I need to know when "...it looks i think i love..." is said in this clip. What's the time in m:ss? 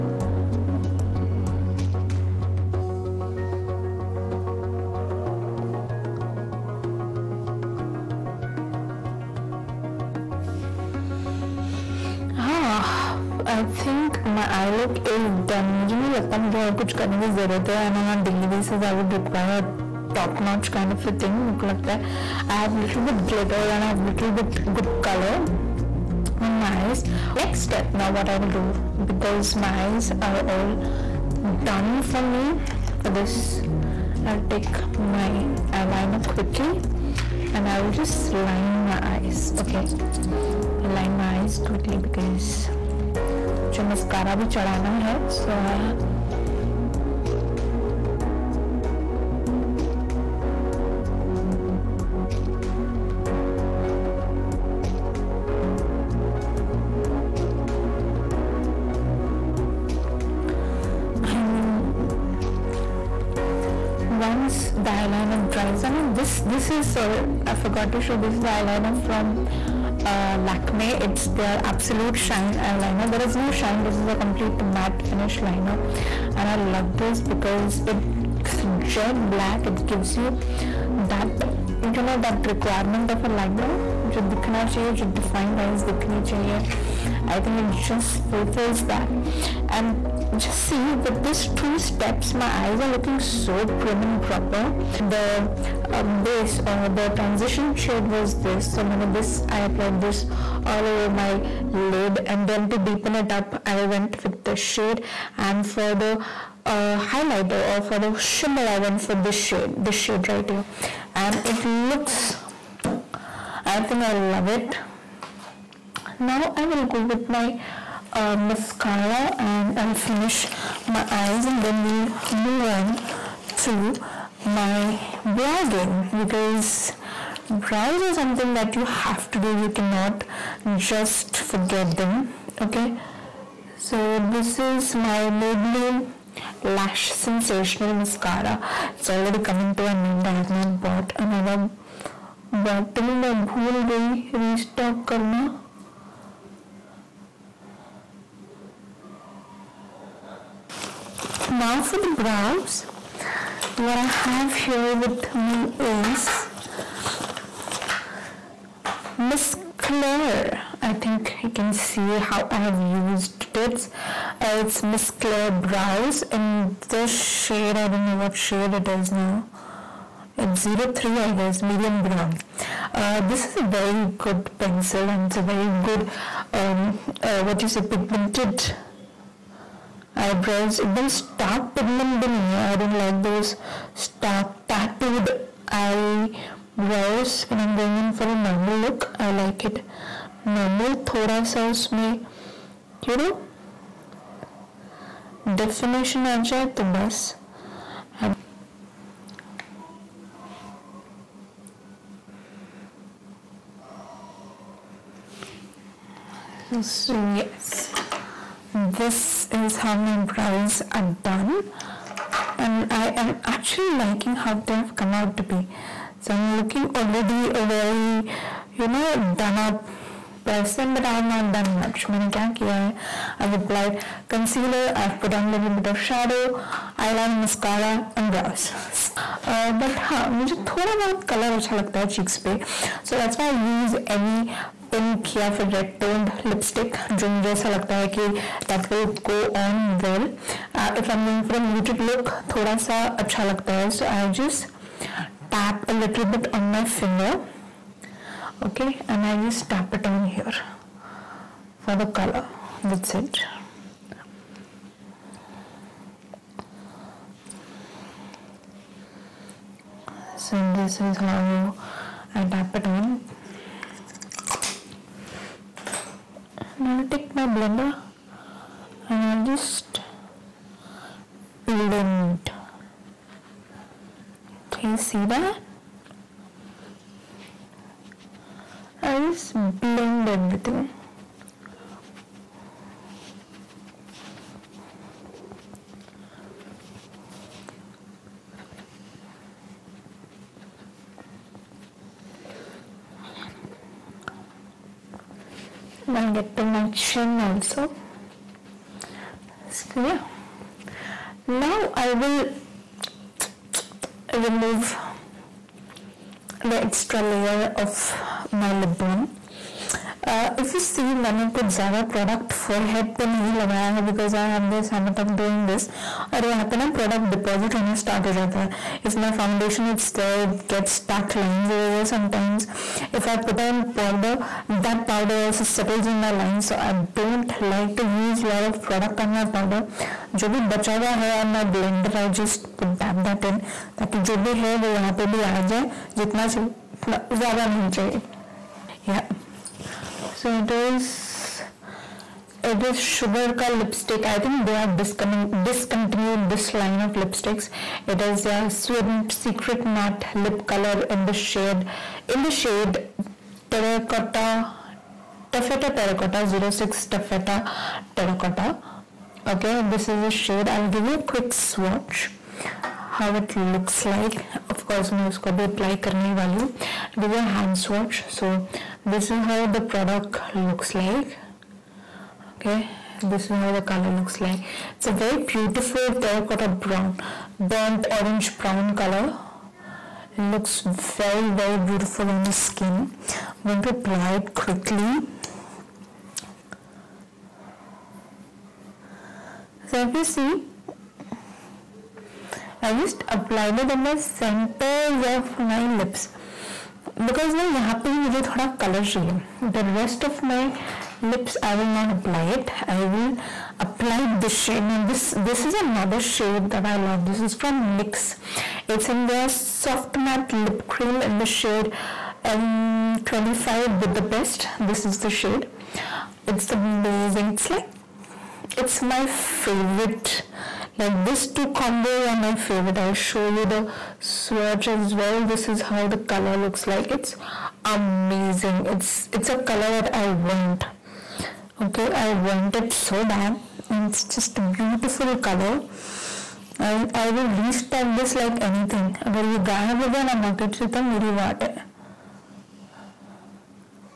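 1:51.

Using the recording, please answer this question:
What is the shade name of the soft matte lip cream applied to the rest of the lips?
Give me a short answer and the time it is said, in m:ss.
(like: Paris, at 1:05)
M25 Budapest, at 6:52.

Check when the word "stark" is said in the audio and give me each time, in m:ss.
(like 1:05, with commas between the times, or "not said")
not said.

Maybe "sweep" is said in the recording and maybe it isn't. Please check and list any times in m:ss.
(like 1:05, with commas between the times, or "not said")
not said.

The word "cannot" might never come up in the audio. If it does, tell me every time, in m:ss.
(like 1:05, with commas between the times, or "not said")
2:09.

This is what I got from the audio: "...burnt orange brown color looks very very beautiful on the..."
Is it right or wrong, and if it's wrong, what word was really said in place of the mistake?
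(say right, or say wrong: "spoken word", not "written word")
right.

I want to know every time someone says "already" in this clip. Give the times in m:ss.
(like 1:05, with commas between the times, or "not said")
2:19, 3:36.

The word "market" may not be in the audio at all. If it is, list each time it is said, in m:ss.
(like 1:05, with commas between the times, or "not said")
7:20.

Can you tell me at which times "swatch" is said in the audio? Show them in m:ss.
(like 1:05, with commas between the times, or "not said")
6:01, 6:07, 7:04.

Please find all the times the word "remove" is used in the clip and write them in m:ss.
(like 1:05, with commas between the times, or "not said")
5:04.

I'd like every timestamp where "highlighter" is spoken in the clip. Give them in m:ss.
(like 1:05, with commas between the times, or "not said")
1:46.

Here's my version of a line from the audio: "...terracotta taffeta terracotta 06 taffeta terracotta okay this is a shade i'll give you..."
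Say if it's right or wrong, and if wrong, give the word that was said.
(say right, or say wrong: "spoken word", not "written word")
right.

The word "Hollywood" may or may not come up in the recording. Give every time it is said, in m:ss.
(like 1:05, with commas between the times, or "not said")
not said.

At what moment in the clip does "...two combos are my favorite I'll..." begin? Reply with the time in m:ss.
7:01.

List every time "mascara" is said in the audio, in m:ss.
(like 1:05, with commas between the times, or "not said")
1:58, 2:17, 3:47.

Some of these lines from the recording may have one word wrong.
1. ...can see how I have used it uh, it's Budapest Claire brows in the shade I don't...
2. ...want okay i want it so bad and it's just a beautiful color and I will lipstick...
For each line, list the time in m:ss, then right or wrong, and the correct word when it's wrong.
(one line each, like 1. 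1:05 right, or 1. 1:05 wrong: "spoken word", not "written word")
1. 2:41 wrong: "Miss", not "Budapest"
2. 7:10 wrong: "restock", not "lipstick".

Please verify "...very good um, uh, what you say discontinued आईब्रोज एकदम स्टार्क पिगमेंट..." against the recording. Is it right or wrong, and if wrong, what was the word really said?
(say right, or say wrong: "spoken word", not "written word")
wrong: "pigmented", not "discontinued".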